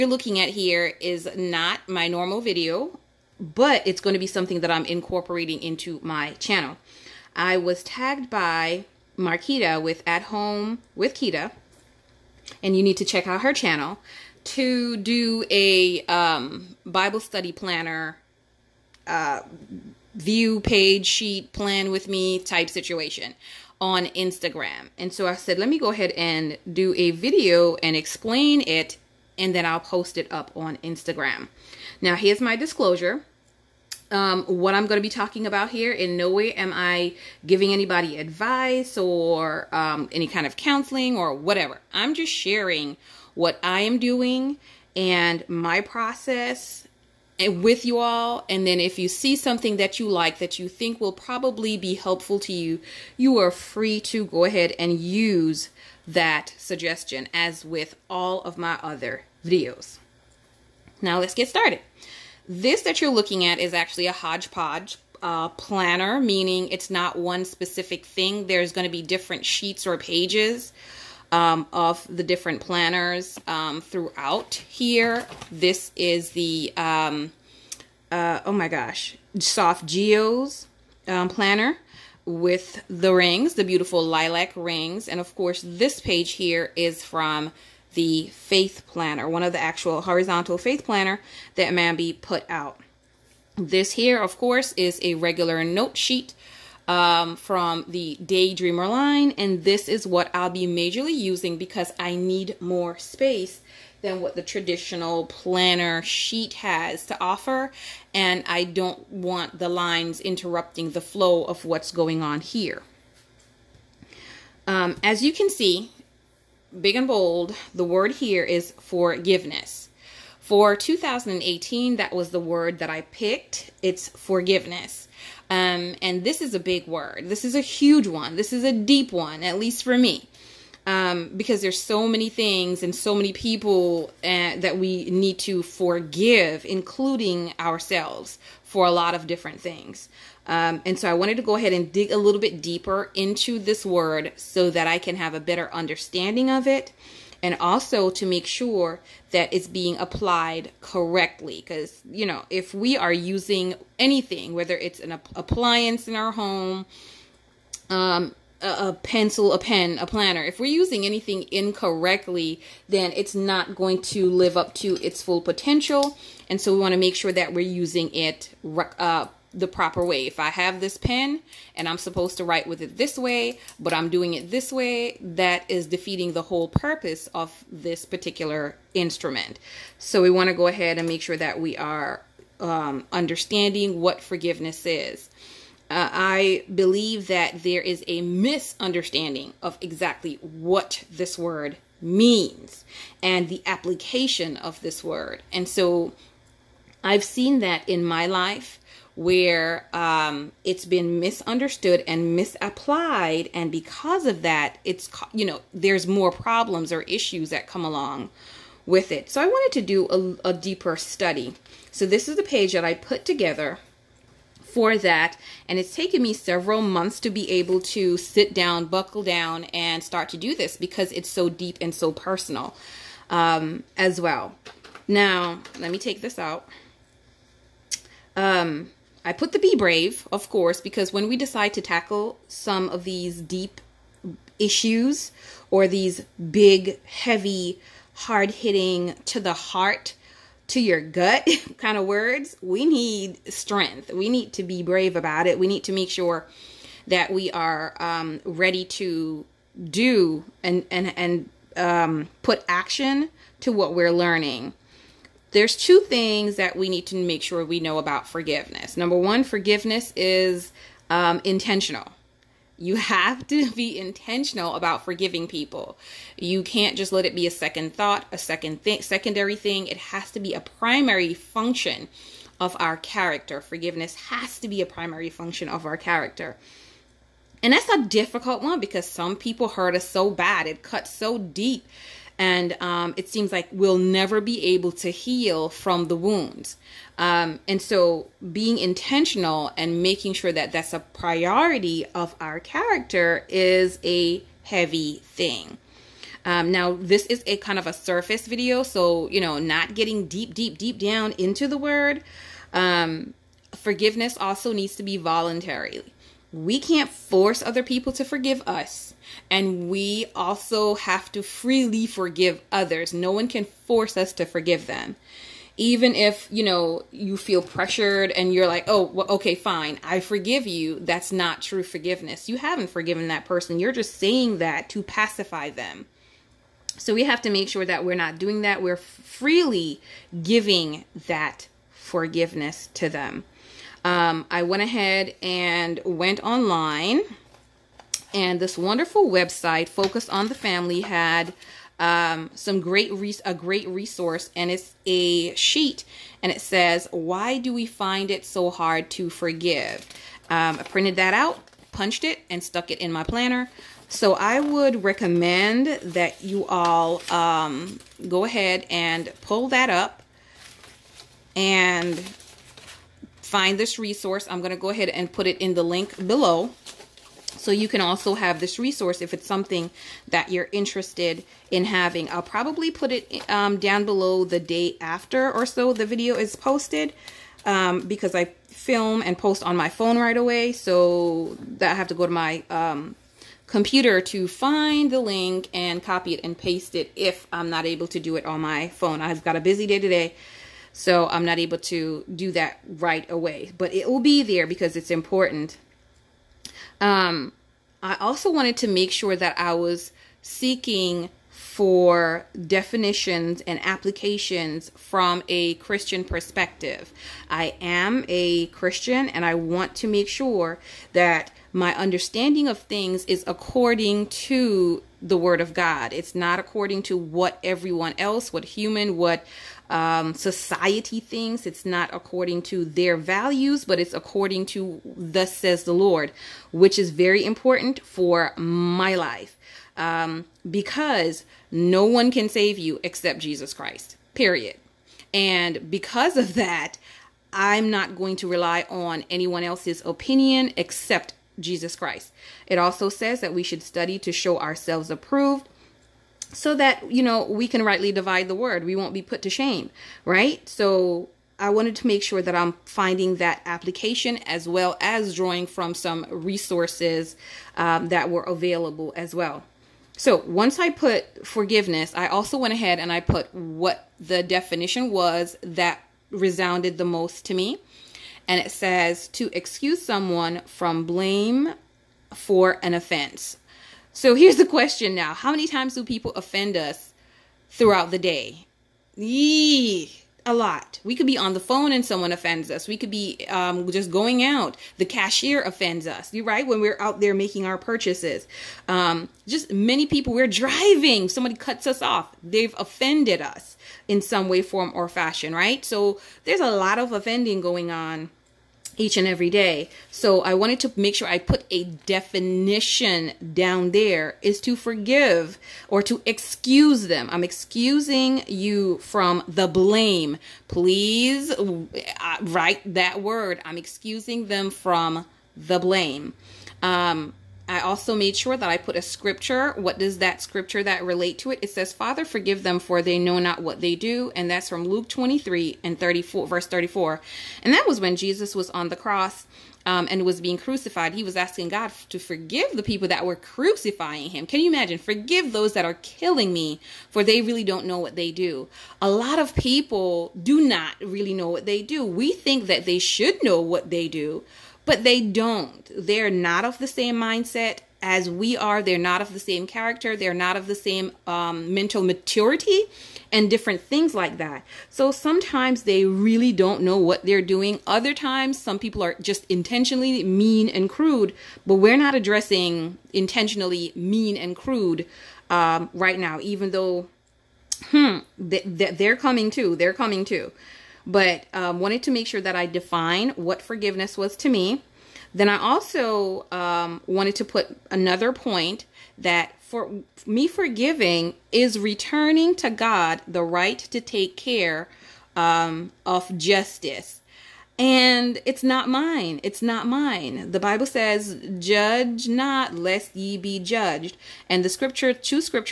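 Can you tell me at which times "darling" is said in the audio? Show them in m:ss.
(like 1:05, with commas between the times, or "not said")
not said.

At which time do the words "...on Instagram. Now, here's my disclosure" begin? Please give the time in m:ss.
0:30.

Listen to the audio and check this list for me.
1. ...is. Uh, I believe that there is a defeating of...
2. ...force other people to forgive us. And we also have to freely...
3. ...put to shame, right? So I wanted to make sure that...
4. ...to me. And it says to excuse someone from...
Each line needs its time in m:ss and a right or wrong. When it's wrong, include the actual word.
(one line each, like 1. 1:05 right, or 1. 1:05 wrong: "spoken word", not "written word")
1. 3:04 wrong: "misunderstanding", not "defeating"
2. 5:07 right
3. 7:29 right
4. 7:47 right.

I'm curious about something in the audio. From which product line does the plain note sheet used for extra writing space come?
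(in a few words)
Daydreamer.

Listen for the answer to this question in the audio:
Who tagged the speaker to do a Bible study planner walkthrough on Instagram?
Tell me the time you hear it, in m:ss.
0:09.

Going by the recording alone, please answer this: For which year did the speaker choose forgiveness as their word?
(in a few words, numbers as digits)
2018.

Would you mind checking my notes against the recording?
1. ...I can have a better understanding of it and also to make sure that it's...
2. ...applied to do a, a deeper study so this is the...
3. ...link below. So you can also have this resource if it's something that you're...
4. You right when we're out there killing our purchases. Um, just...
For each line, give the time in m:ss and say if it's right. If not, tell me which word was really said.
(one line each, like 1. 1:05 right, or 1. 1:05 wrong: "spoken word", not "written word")
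1. 2:24 right
2. 3:29 wrong: "wanted", not "applied"
3. 6:05 right
4. 8:06 wrong: "making", not "killing".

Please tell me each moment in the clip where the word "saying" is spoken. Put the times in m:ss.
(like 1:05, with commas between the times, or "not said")
5:24.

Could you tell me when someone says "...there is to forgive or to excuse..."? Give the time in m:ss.
8:23.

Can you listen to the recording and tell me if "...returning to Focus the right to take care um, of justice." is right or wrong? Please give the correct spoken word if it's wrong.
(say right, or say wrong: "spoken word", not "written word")
wrong: "God", not "Focus".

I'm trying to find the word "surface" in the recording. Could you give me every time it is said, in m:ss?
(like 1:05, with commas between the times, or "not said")
4:57.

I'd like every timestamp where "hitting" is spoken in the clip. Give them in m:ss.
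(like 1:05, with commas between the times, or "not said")
3:58.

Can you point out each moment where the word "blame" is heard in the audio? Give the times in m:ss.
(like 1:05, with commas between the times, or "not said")
7:51, 8:29, 8:35.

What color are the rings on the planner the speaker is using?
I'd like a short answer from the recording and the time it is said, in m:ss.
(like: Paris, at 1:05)
lilac, at 1:24.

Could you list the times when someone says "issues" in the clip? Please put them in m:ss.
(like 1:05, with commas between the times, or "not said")
3:27, 3:54.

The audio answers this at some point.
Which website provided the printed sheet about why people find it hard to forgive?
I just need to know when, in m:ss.
5:39.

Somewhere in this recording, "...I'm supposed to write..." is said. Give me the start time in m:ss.
2:51.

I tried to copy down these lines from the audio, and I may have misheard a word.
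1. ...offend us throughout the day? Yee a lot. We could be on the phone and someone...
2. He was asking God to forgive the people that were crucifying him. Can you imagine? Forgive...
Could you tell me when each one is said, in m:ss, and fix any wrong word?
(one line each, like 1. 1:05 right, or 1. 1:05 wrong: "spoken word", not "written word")
1. 7:56 right
2. 8:51 right.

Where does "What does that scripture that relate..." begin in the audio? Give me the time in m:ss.
8:39.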